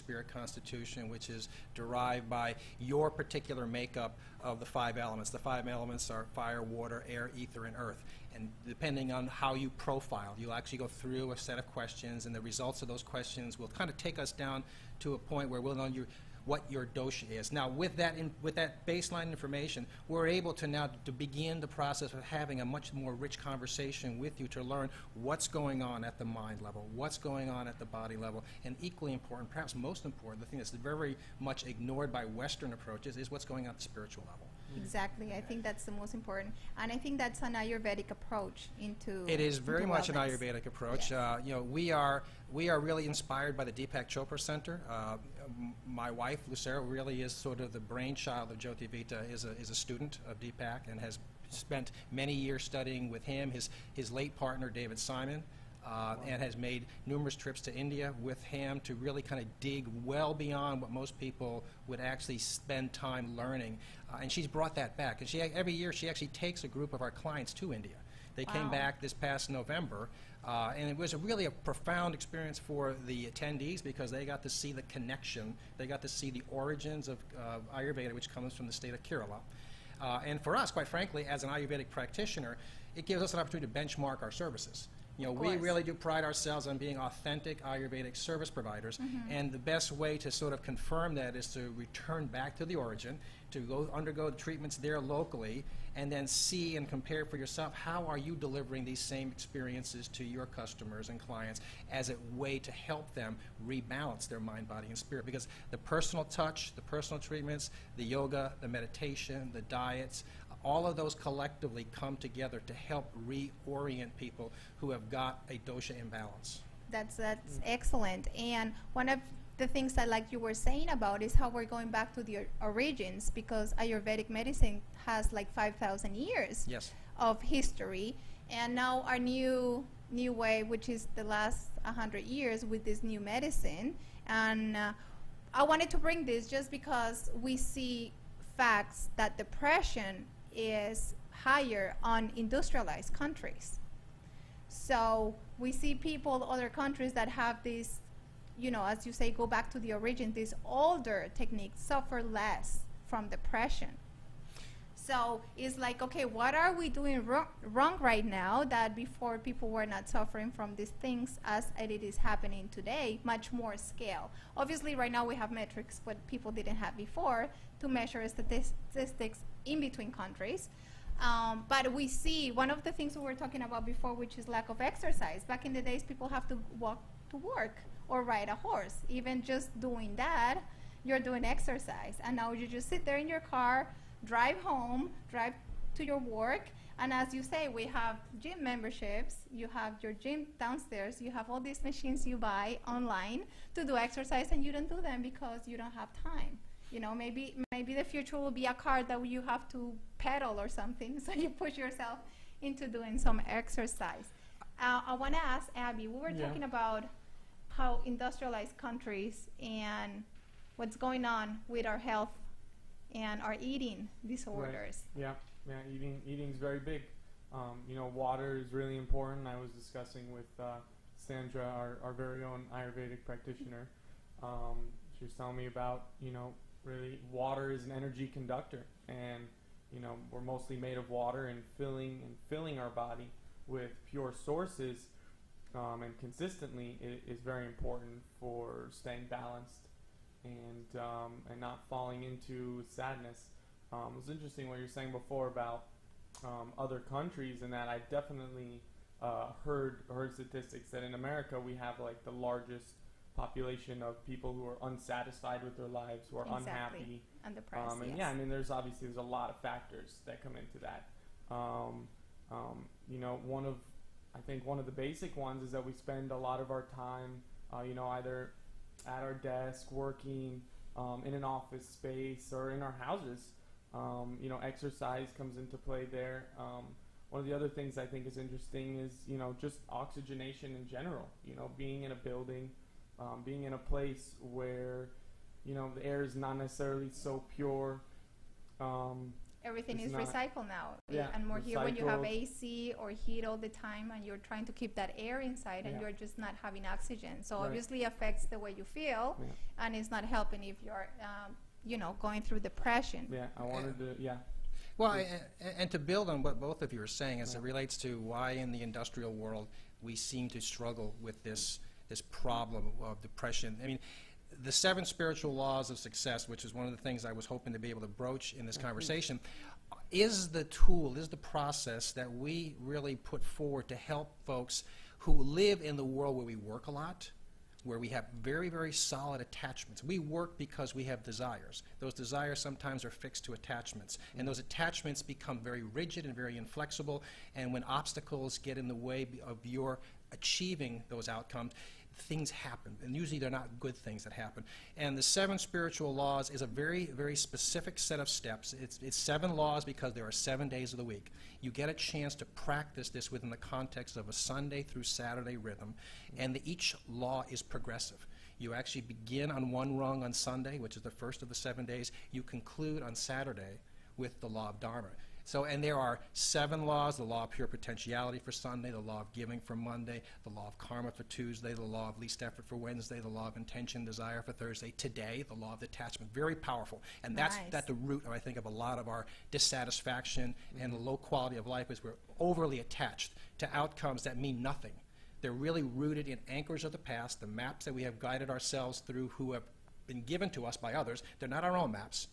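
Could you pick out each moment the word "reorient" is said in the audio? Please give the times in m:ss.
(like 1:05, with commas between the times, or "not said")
1:53.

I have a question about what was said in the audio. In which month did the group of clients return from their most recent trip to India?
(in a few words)
November.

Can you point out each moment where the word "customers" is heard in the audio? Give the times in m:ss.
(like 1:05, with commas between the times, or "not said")
1:40.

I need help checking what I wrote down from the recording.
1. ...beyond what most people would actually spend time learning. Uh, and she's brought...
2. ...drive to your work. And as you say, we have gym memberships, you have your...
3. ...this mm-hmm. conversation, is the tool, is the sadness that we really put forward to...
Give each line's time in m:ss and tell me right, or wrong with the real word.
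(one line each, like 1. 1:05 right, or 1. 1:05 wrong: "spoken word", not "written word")
1. 1:00 right
2. 3:05 right
3. 5:18 wrong: "process", not "sadness".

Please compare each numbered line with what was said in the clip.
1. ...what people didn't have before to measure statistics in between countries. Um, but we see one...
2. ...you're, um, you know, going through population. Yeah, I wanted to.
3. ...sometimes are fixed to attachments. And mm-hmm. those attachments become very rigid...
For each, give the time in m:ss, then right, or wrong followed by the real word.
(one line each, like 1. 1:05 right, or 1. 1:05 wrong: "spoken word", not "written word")
1. 2:46 right
2. 5:00 wrong: "depression", not "population"
3. 5:32 right.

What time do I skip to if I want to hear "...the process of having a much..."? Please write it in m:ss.
0:21.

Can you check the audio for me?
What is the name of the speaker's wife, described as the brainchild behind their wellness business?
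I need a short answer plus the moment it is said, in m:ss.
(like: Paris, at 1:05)
Lucero, at 0:46.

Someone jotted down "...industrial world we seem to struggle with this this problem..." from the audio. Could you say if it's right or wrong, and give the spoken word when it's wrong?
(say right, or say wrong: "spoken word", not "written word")
right.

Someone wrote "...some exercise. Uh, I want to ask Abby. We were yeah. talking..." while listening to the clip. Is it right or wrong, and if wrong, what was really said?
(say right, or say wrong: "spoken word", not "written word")
right.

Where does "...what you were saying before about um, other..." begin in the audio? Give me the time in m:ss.
4:04.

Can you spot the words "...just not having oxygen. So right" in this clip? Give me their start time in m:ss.
4:56.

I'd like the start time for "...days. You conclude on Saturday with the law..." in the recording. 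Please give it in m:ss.
6:01.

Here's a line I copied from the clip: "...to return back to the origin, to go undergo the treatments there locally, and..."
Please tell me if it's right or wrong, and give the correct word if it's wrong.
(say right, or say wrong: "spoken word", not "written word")
right.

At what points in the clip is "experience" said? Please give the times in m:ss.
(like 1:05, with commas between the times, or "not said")
1:12, 1:39.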